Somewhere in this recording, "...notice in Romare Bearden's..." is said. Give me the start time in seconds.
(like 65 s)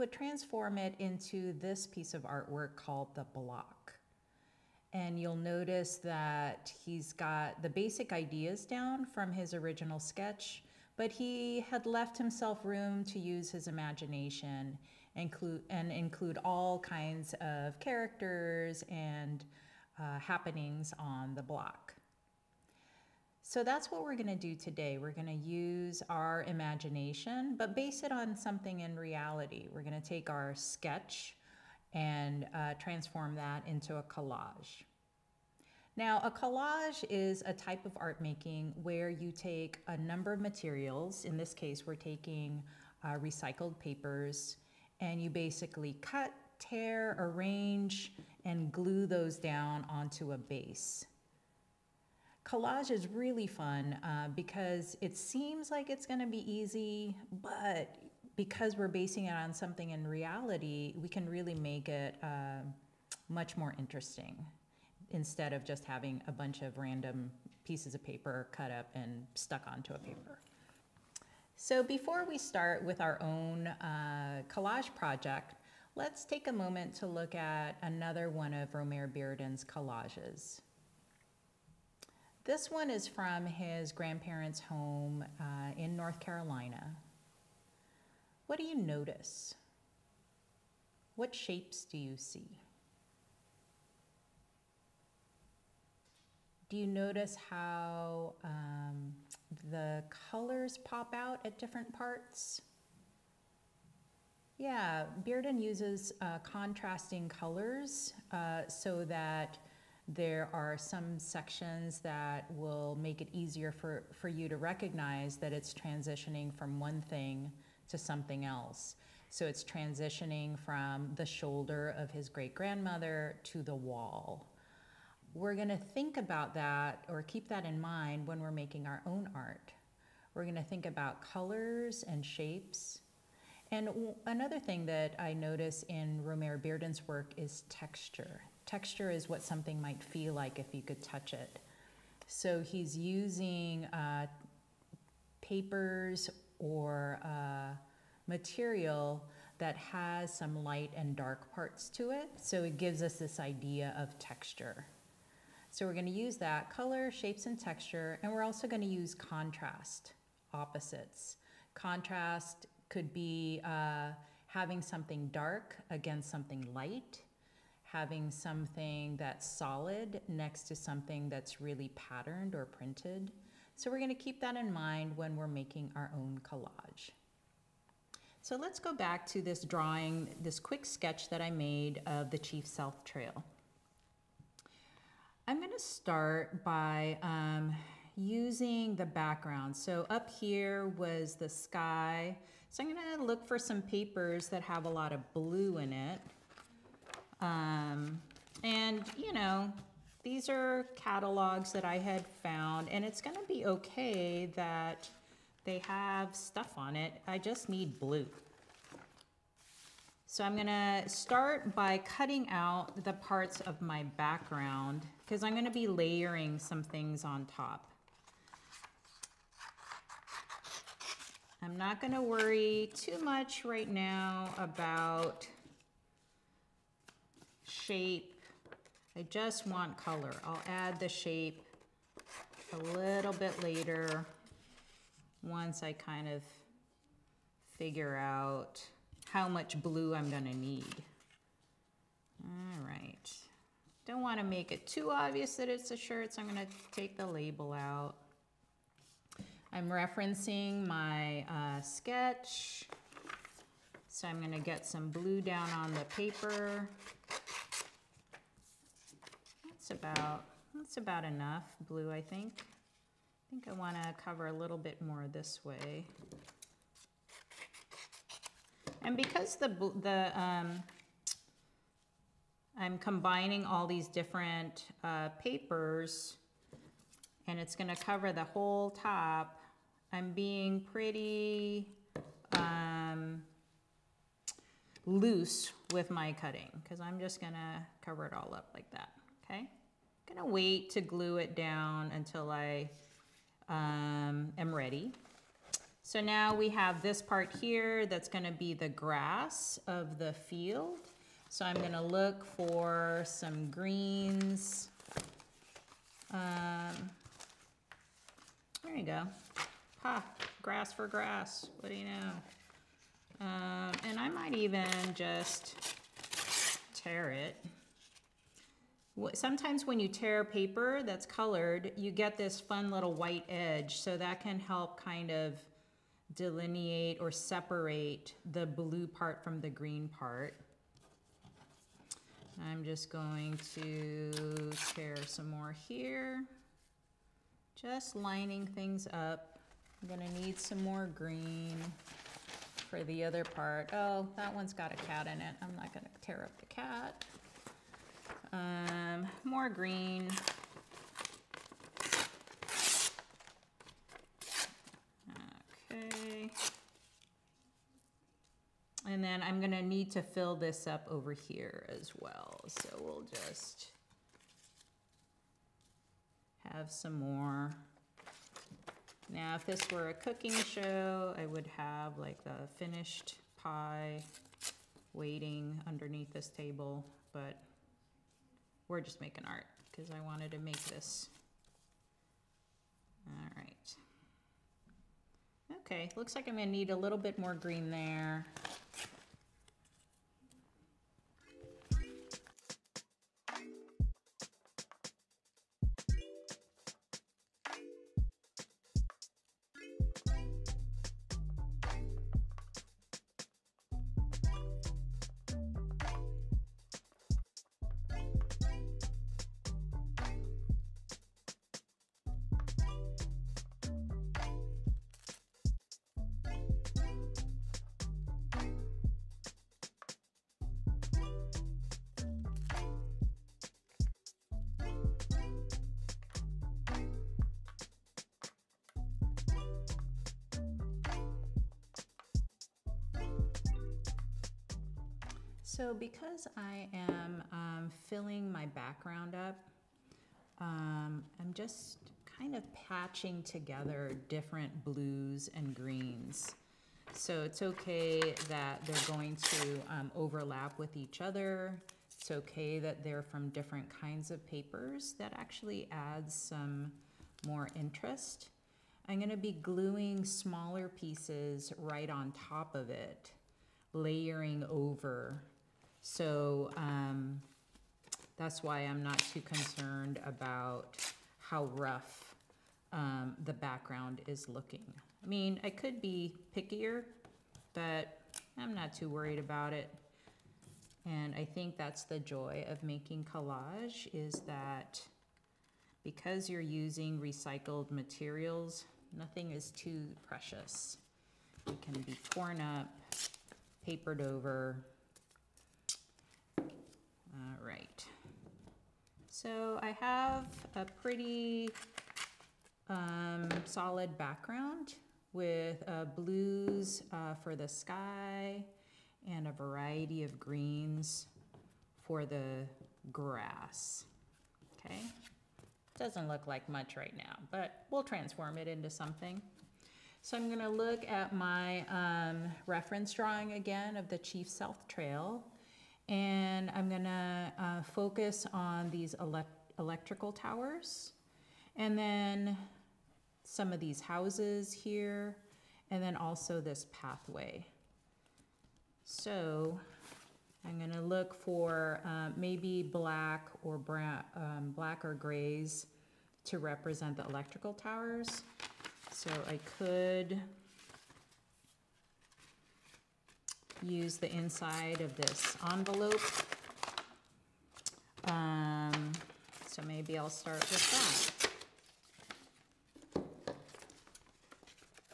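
135 s.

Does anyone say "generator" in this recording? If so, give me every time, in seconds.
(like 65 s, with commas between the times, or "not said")
not said.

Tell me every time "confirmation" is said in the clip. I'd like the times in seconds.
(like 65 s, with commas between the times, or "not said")
not said.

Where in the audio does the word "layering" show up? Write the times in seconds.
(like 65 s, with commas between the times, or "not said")
215 s, 463 s.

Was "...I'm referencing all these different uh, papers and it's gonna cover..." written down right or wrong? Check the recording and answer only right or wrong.
wrong.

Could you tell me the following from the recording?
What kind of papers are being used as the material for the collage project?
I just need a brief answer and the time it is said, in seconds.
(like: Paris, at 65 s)
Recycled papers, at 43 s.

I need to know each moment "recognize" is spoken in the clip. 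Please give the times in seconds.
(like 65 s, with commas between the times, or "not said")
114 s.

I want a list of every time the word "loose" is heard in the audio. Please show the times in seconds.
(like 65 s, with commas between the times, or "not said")
285 s.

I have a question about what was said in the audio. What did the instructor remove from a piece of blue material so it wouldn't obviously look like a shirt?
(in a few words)
The label.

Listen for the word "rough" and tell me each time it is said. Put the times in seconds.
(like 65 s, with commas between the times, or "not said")
471 s.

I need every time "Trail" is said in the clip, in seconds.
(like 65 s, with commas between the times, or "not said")
183 s, 524 s.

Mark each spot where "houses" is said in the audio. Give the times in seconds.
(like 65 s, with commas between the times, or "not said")
533 s.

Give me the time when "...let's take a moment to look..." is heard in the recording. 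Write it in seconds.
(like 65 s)
75 s.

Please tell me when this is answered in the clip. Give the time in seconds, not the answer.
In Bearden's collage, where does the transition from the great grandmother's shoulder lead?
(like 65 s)
123 s.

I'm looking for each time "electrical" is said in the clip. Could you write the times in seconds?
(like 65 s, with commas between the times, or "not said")
529 s, 547 s.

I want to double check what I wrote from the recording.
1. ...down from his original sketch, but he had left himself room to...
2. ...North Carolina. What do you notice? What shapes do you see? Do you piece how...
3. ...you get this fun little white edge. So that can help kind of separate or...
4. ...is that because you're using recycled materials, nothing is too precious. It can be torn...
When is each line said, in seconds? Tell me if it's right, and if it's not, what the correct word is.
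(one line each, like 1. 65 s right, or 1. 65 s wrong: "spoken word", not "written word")
1. 8 s right
2. 85 s wrong: "notice", not "piece"
3. 321 s wrong: "delineate", not "separate"
4. 484 s right.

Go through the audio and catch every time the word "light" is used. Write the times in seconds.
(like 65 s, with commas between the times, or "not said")
150 s, 166 s.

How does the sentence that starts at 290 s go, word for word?
I'm gonna wait to glue it down until I um, am ready.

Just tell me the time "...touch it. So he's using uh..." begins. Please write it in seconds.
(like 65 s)
141 s.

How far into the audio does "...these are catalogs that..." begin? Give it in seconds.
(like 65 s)
200 s.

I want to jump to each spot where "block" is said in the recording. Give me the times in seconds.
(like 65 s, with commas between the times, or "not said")
3 s, 21 s.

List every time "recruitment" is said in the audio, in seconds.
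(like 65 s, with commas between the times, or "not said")
not said.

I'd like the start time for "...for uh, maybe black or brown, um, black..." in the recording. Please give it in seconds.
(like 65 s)
541 s.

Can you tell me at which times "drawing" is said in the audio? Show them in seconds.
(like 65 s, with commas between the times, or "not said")
179 s, 523 s.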